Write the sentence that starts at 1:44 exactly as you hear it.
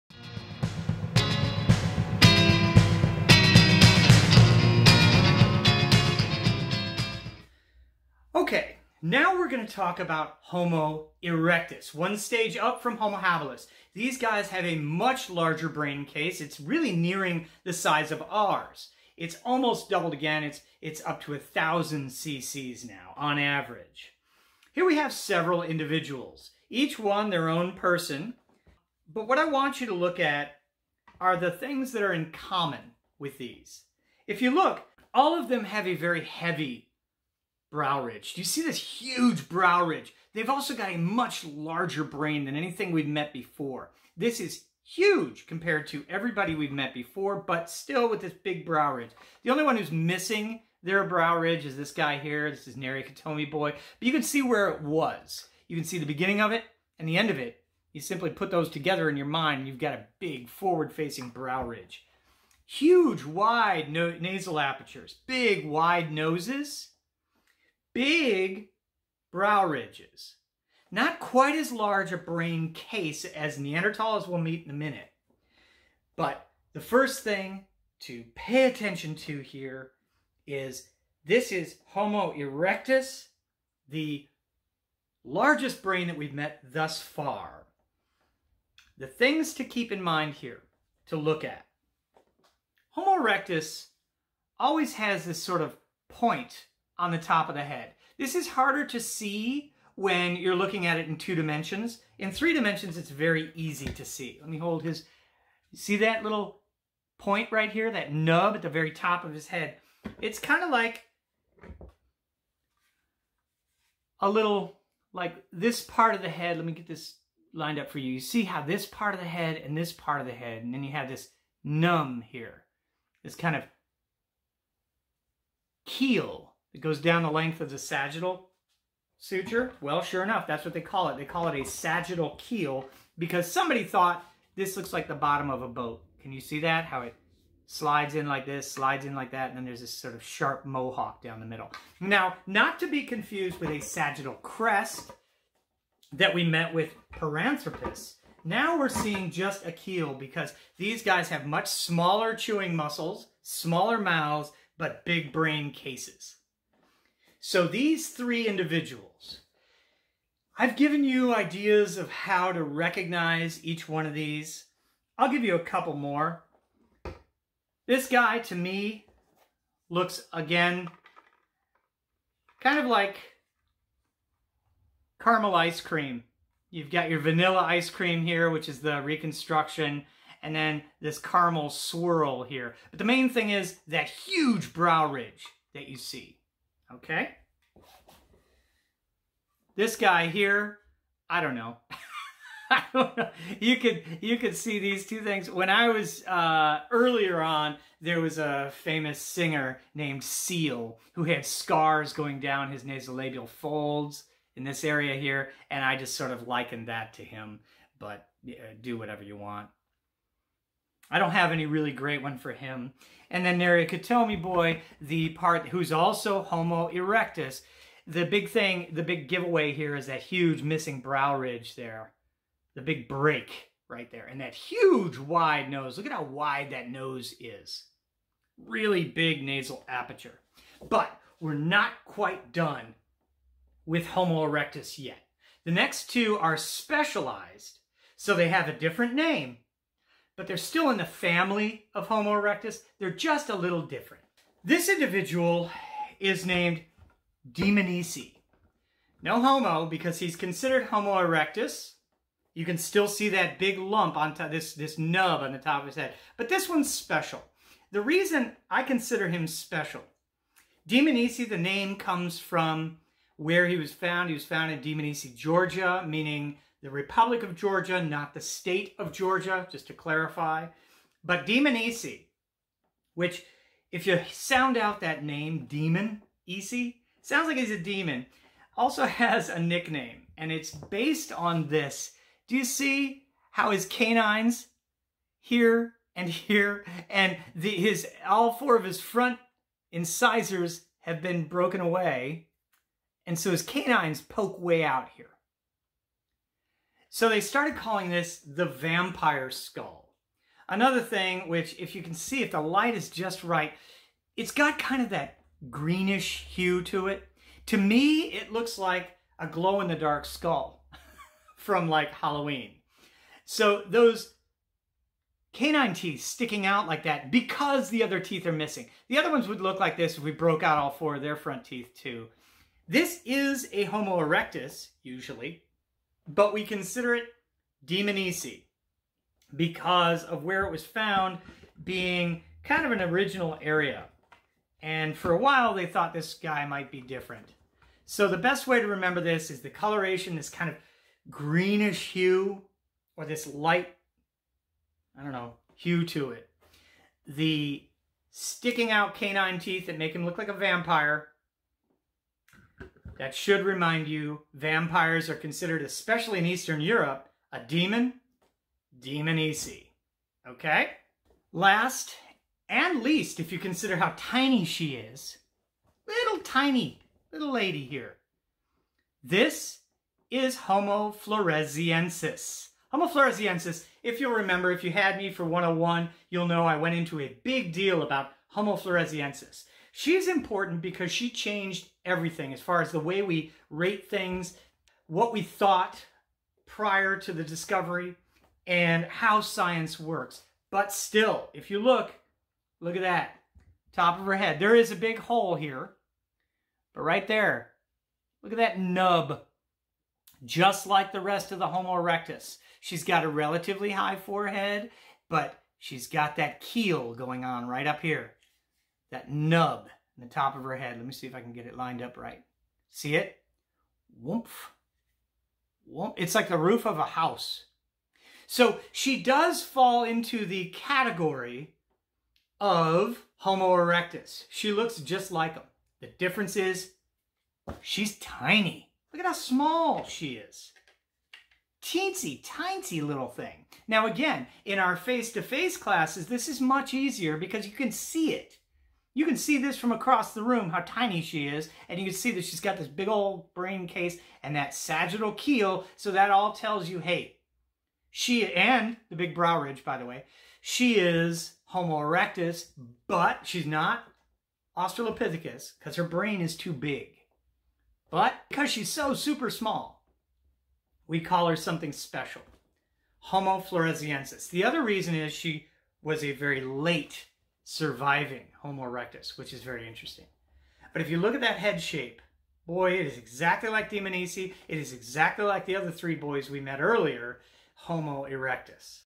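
Let me hold his, see that little point right here, that nub at the very top of his head?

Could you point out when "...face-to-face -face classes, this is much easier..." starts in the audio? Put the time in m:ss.
7:14.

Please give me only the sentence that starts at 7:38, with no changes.
But because she's so super small, we call her something special, Homo floresiensis.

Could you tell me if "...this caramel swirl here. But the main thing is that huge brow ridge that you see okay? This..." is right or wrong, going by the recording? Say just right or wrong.
right.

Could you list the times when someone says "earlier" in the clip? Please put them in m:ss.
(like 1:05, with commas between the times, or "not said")
3:16, 7:56.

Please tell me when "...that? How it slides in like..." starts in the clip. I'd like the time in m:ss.
2:16.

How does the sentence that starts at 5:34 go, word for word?
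And for a while, they thought this guy might be different.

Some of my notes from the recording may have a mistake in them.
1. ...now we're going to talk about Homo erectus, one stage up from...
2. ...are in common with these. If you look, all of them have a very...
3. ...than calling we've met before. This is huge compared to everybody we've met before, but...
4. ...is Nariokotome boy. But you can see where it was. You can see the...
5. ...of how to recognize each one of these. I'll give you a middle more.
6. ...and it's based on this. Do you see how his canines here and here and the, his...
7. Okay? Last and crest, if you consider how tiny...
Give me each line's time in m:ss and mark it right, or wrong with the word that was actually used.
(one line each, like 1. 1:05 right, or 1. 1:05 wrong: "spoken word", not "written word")
1. 0:09 right
2. 0:32 right
3. 0:42 wrong: "anything", not "calling"
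4. 0:52 right
5. 2:41 wrong: "couple", not "middle"
6. 4:40 right
7. 6:00 wrong: "least", not "crest".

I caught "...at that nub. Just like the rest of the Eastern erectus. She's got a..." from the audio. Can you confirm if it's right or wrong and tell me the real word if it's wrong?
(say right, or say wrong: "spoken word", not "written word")
wrong: "Homo", not "Eastern".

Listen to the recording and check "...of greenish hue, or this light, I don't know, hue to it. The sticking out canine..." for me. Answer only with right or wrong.
right.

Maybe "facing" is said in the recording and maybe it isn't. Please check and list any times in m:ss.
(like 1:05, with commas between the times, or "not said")
1:00.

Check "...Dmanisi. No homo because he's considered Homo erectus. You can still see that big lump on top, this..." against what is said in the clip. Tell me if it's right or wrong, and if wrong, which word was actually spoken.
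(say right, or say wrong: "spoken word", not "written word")
right.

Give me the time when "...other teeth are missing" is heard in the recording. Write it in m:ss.
5:18.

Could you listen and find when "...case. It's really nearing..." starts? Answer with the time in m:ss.
0:16.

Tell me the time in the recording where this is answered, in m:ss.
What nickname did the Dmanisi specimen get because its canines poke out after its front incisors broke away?
4:58.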